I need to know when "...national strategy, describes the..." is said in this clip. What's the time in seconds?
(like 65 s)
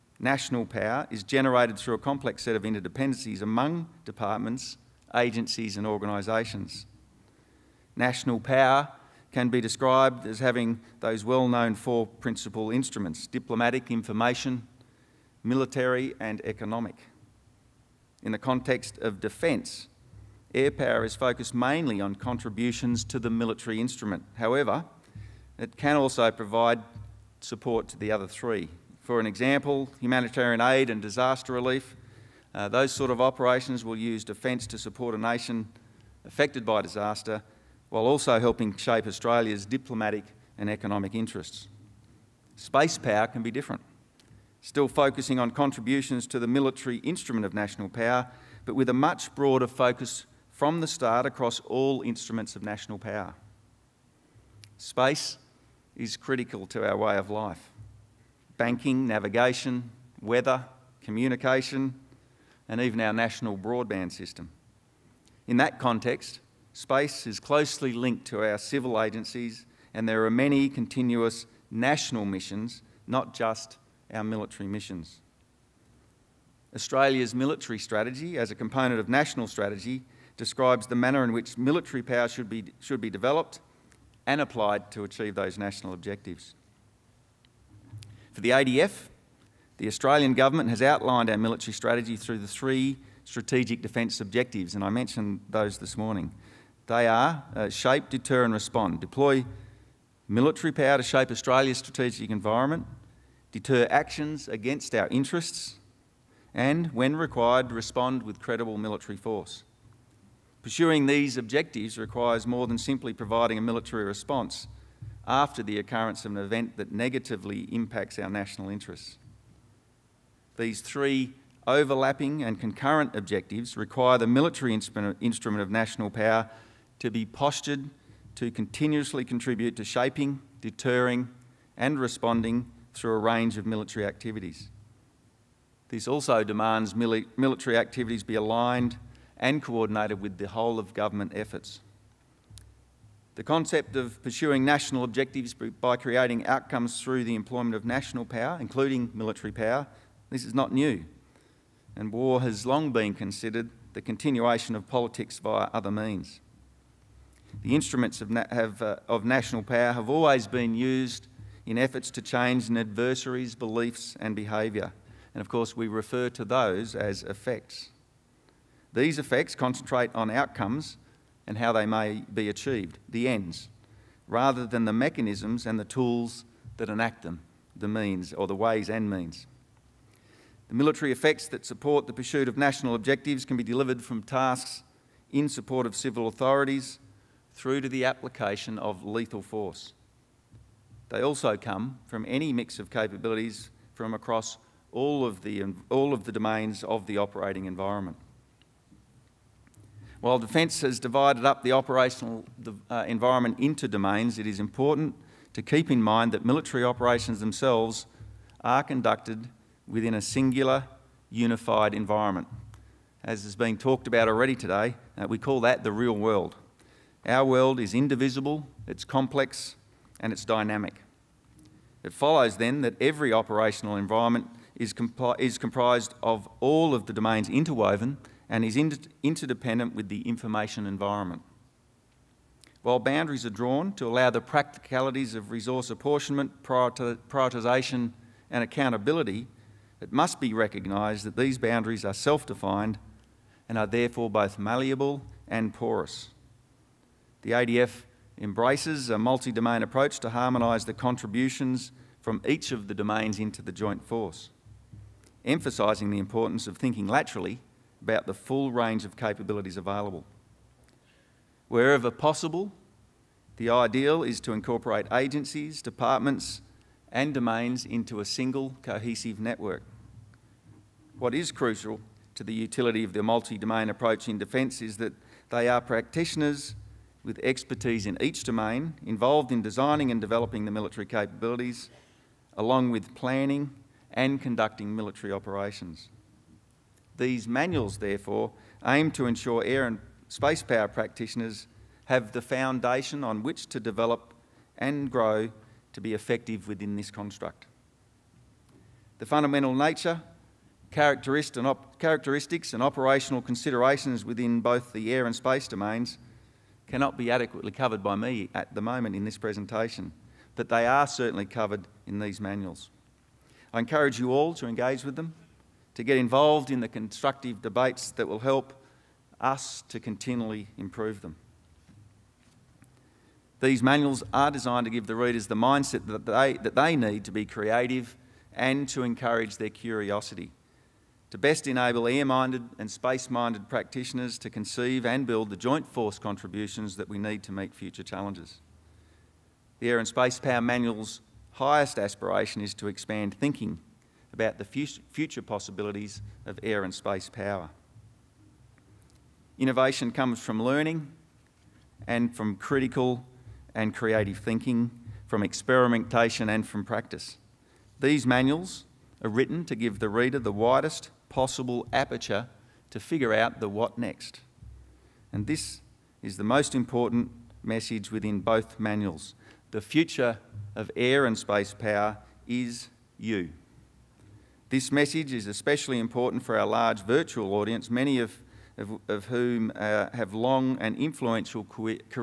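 79 s.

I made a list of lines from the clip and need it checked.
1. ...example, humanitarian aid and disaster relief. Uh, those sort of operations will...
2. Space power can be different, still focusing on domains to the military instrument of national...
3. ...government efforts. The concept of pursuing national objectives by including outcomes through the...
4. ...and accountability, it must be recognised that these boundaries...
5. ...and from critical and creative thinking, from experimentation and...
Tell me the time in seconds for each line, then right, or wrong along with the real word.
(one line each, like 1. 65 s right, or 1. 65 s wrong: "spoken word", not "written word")
1. 29 s right
2. 42 s wrong: "contributions", not "domains"
3. 140 s wrong: "creating", not "including"
4. 238 s right
5. 352 s right.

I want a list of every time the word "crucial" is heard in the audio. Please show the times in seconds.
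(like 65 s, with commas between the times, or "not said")
271 s.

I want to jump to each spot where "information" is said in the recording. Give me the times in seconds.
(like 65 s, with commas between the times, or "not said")
13 s, 230 s.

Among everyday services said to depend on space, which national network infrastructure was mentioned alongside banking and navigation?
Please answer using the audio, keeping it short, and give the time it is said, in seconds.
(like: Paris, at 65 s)
national broadband system, at 63 s.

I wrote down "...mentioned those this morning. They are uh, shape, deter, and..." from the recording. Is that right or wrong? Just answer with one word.
right.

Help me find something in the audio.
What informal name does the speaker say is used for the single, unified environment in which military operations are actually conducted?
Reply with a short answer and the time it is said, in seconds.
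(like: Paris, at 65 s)
the real world, at 215 s.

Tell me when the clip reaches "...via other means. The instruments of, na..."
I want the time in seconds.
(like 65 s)
155 s.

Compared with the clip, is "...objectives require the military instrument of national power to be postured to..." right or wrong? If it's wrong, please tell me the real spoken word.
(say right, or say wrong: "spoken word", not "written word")
right.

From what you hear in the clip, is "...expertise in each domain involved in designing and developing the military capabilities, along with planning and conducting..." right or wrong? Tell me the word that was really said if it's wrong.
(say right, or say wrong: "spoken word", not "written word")
right.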